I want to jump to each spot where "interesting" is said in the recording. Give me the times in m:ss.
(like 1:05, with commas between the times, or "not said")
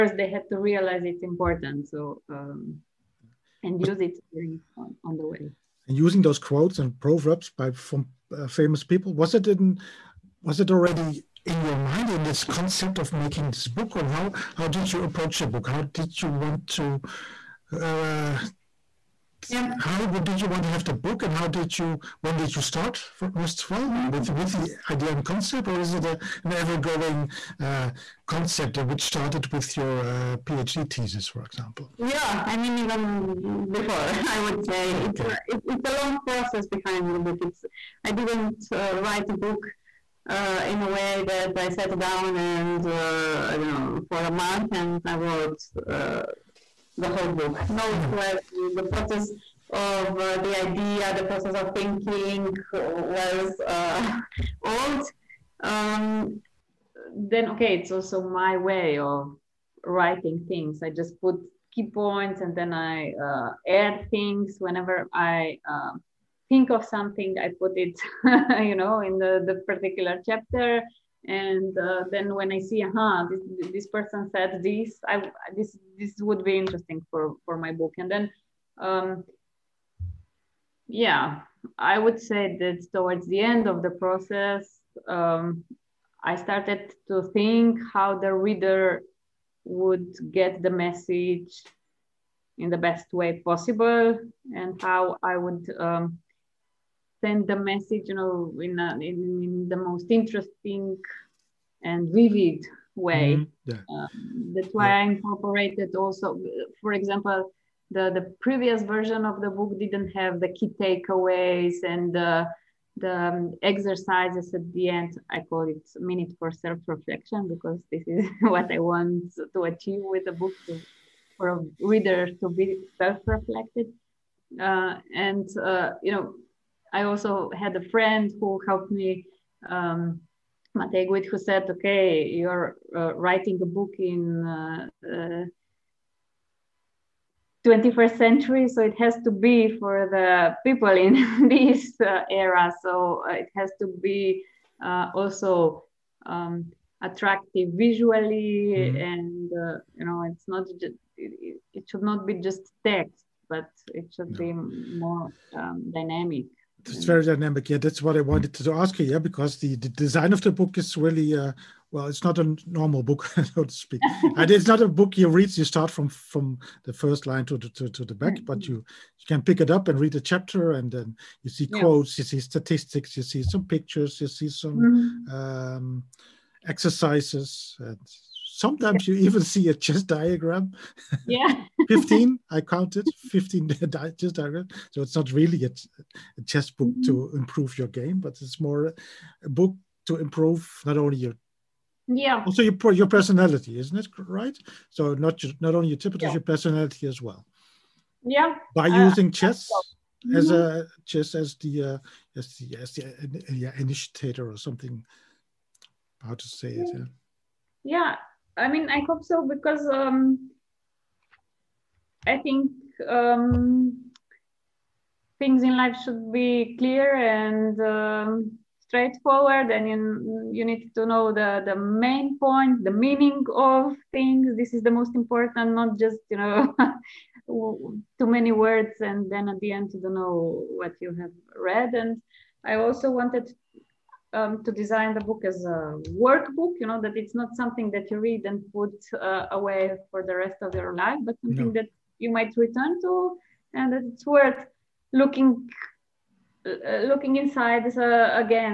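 1:16, 1:40.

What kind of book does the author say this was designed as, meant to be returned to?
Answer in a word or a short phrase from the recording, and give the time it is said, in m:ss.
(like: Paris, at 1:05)
A workbook, at 3:56.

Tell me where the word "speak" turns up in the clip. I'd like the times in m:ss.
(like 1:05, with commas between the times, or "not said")
2:43.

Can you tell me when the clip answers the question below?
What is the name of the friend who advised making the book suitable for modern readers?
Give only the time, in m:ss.
2:10.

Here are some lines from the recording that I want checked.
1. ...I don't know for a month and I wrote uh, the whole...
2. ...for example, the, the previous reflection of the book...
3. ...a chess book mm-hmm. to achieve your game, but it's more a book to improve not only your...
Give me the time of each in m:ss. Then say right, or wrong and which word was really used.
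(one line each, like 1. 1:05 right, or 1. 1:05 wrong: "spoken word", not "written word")
1. 0:43 right
2. 1:46 wrong: "version", not "reflection"
3. 3:06 wrong: "improve", not "achieve".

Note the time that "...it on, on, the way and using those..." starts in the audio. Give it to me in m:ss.
0:04.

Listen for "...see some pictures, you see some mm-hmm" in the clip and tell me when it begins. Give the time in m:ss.
2:53.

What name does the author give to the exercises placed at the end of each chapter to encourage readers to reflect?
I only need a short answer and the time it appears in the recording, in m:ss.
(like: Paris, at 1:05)
Minute for self reflection, at 1:55.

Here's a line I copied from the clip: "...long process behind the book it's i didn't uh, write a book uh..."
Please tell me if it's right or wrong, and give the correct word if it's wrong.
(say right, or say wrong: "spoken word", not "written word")
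right.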